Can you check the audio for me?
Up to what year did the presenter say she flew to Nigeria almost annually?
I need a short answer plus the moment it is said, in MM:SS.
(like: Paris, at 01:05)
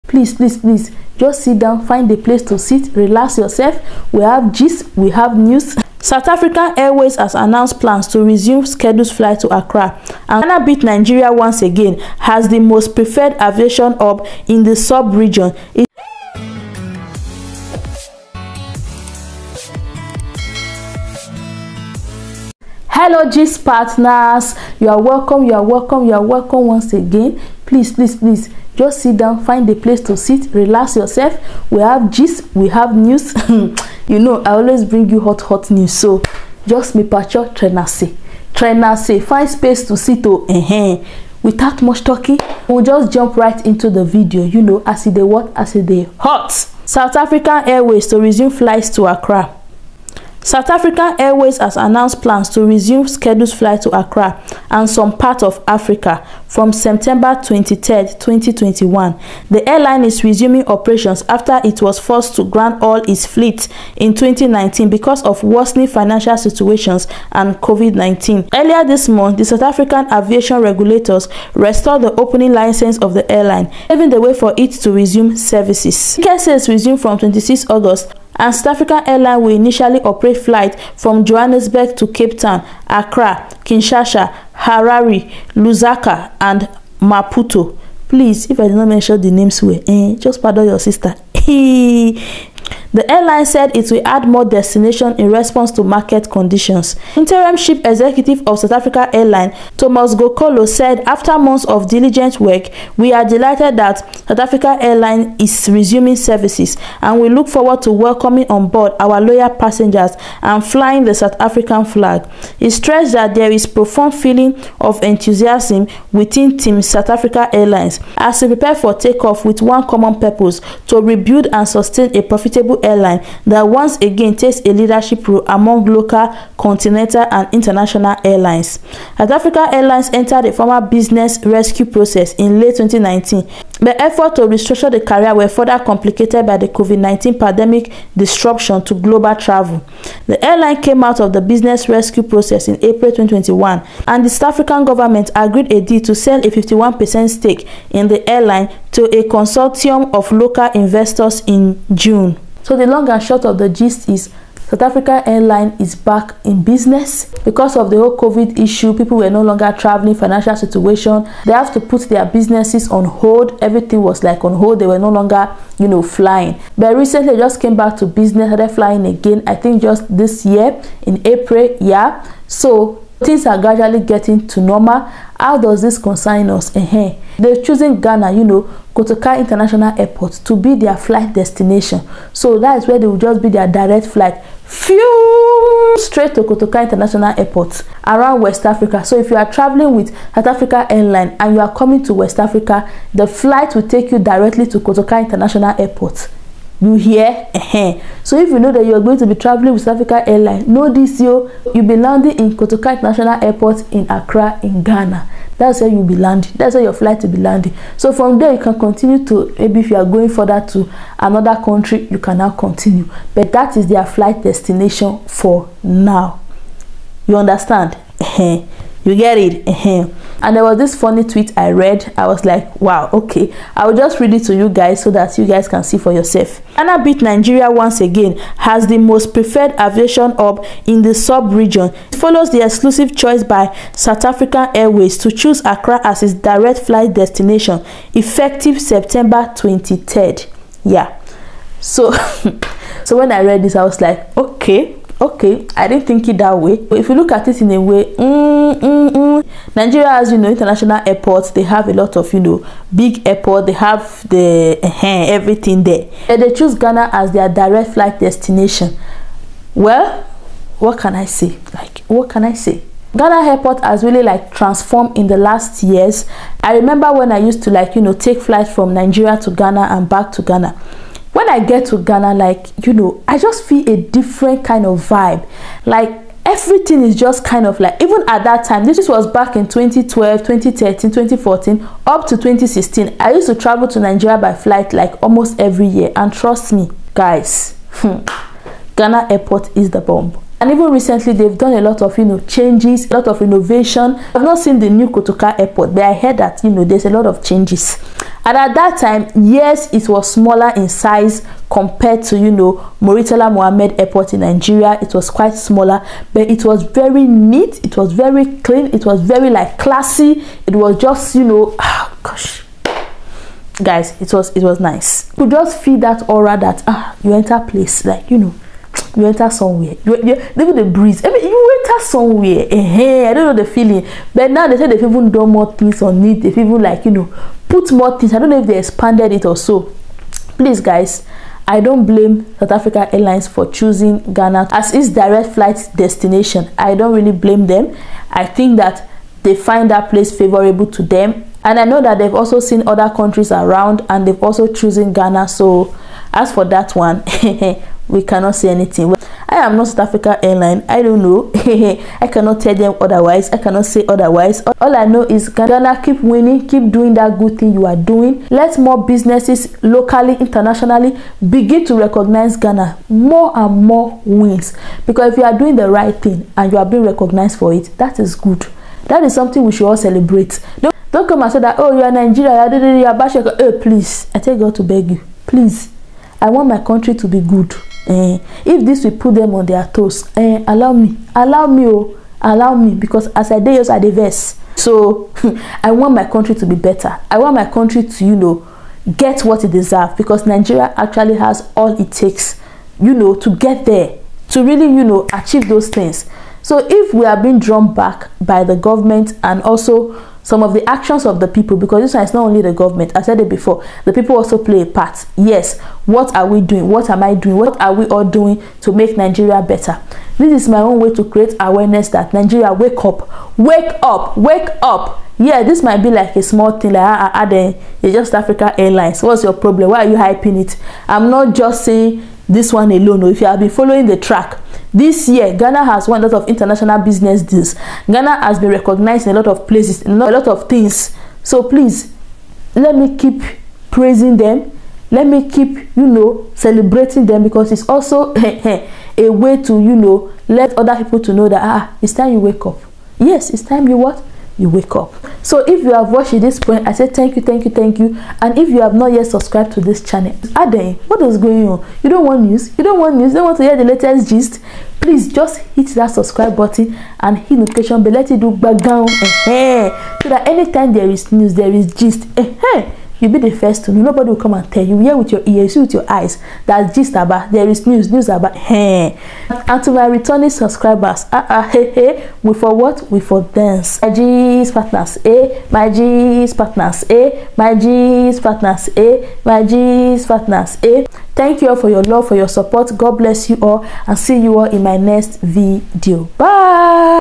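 2016, at 04:42.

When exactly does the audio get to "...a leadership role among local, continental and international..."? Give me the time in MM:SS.
02:04.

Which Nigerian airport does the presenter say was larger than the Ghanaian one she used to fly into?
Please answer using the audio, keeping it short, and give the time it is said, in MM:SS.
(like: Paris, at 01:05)
Murtala Muhammed Airport, at 05:03.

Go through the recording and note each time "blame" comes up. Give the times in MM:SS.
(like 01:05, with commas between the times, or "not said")
05:32, 05:37.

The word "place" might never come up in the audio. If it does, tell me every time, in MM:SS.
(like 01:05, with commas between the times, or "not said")
00:02, 00:29, 05:17, 05:40, 07:09.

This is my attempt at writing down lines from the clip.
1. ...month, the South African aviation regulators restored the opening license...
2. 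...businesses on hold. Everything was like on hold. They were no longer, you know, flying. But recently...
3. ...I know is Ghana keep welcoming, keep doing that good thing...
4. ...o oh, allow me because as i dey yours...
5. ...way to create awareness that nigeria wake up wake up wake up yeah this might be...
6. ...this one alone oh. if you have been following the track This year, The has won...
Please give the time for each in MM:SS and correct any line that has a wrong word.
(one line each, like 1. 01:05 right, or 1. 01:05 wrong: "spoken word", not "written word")
1. 01:09 right
2. 02:42 right
3. 05:54 wrong: "winning", not "welcoming"
4. 06:21 right
5. 06:50 right
6. 07:02 wrong: "Ghana", not "The".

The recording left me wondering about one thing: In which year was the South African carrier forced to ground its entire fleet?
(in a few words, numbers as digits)
2019.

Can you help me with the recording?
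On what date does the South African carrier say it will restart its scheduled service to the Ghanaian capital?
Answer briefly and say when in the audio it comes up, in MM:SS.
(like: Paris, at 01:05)
September 23, 2021, at 00:56.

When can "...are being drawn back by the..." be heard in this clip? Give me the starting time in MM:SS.
06:37.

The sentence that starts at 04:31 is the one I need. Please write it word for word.
When I get to Ghana, like, you know, I just feel a different kind of vibe.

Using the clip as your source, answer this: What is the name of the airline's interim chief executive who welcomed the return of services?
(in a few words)
Thomas Kgokolo.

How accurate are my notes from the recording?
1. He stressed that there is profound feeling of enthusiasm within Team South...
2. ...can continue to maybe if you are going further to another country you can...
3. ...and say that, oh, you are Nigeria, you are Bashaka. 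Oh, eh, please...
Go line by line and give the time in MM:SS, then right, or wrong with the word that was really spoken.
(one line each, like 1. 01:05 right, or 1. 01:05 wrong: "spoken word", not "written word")
1. 01:52 right
2. 03:28 right
3. 06:11 right.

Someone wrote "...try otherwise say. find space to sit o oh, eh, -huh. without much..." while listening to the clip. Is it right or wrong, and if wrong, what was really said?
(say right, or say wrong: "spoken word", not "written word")
wrong: "trenase", not "otherwise".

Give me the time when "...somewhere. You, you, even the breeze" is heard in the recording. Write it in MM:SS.
05:19.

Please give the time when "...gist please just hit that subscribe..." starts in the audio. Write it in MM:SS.
07:34.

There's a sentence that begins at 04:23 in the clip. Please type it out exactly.
Ghana airport has really like transformed in the last years.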